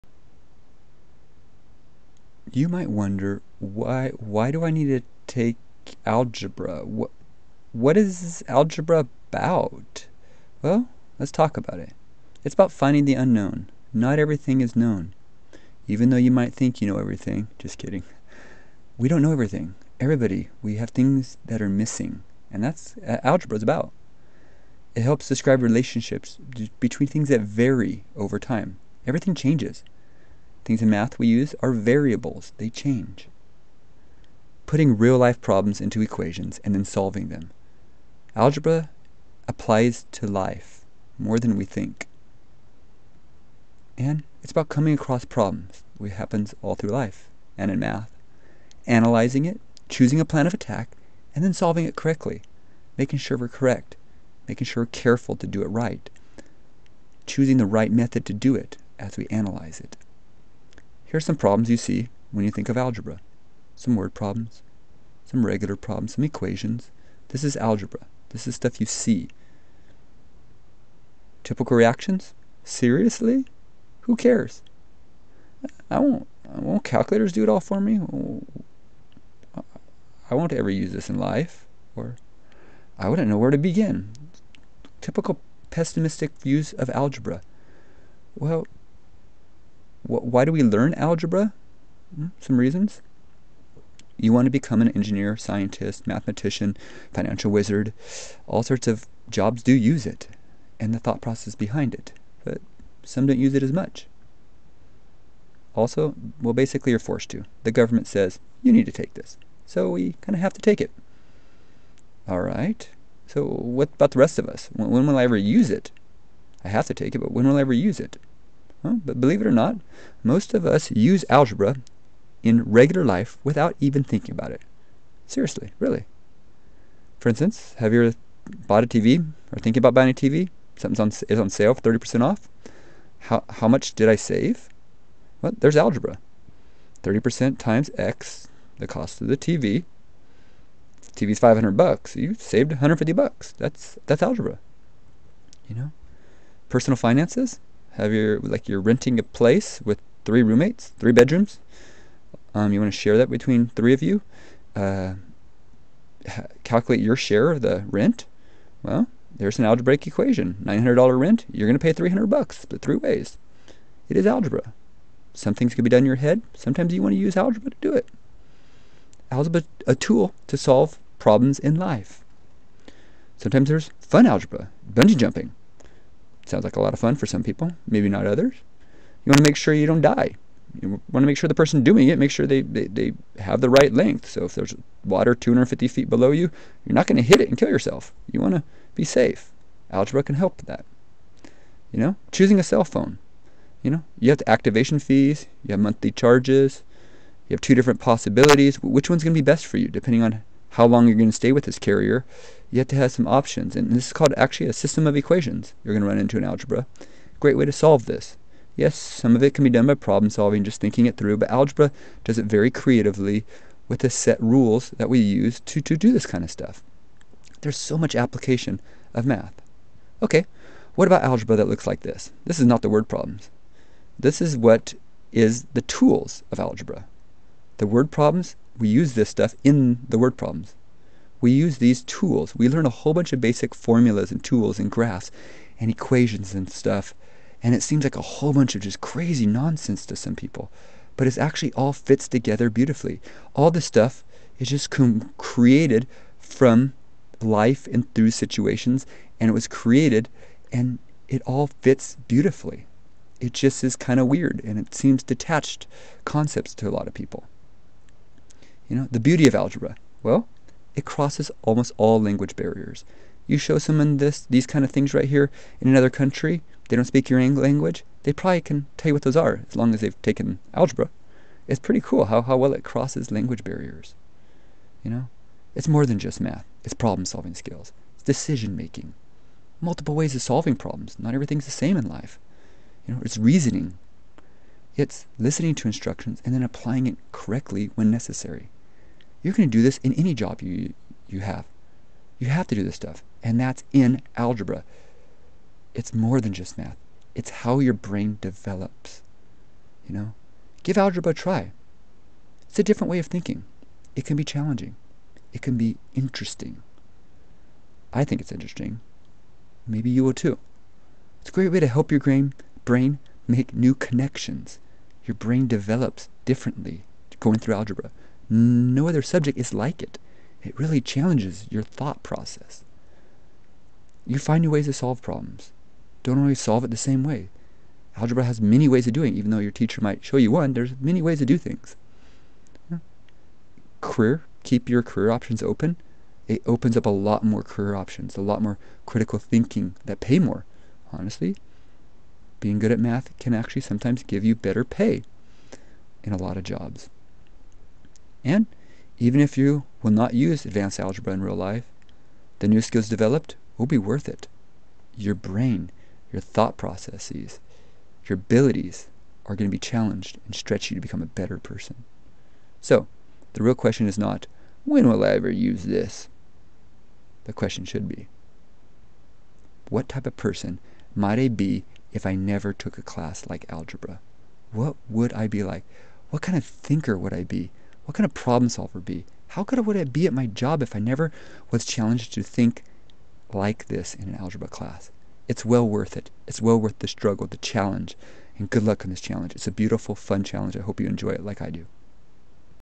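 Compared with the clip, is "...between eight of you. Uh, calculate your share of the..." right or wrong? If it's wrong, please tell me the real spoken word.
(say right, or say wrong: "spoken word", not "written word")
wrong: "three", not "eight".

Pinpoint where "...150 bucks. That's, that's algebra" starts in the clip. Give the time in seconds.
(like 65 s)
142 s.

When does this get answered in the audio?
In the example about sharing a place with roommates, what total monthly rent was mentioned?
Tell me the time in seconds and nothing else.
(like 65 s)
160 s.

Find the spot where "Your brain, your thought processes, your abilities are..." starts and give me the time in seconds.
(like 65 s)
355 s.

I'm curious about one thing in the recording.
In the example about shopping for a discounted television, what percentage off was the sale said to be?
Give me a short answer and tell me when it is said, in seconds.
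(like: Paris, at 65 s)
30%, at 131 s.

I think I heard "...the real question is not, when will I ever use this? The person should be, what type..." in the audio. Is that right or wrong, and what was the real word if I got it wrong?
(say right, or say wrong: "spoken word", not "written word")
wrong: "question", not "person".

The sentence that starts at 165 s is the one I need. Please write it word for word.
Some things can be done in your head.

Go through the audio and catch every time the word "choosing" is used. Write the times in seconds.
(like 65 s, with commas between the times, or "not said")
49 s, 57 s, 192 s.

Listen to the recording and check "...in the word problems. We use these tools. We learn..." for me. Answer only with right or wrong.
right.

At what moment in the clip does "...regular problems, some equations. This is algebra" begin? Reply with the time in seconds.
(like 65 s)
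65 s.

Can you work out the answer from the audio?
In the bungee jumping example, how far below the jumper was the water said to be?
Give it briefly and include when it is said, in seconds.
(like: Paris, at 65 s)
250 feet, at 185 s.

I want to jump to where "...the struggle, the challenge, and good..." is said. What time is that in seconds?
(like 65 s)
386 s.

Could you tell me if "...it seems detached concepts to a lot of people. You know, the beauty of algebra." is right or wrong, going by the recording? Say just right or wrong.
right.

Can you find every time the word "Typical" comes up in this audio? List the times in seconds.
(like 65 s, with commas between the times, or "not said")
71 s, 85 s.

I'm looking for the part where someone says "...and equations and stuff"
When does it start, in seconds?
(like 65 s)
235 s.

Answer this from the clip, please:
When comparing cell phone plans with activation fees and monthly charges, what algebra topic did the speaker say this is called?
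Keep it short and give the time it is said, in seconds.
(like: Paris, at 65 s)
system of equations, at 204 s.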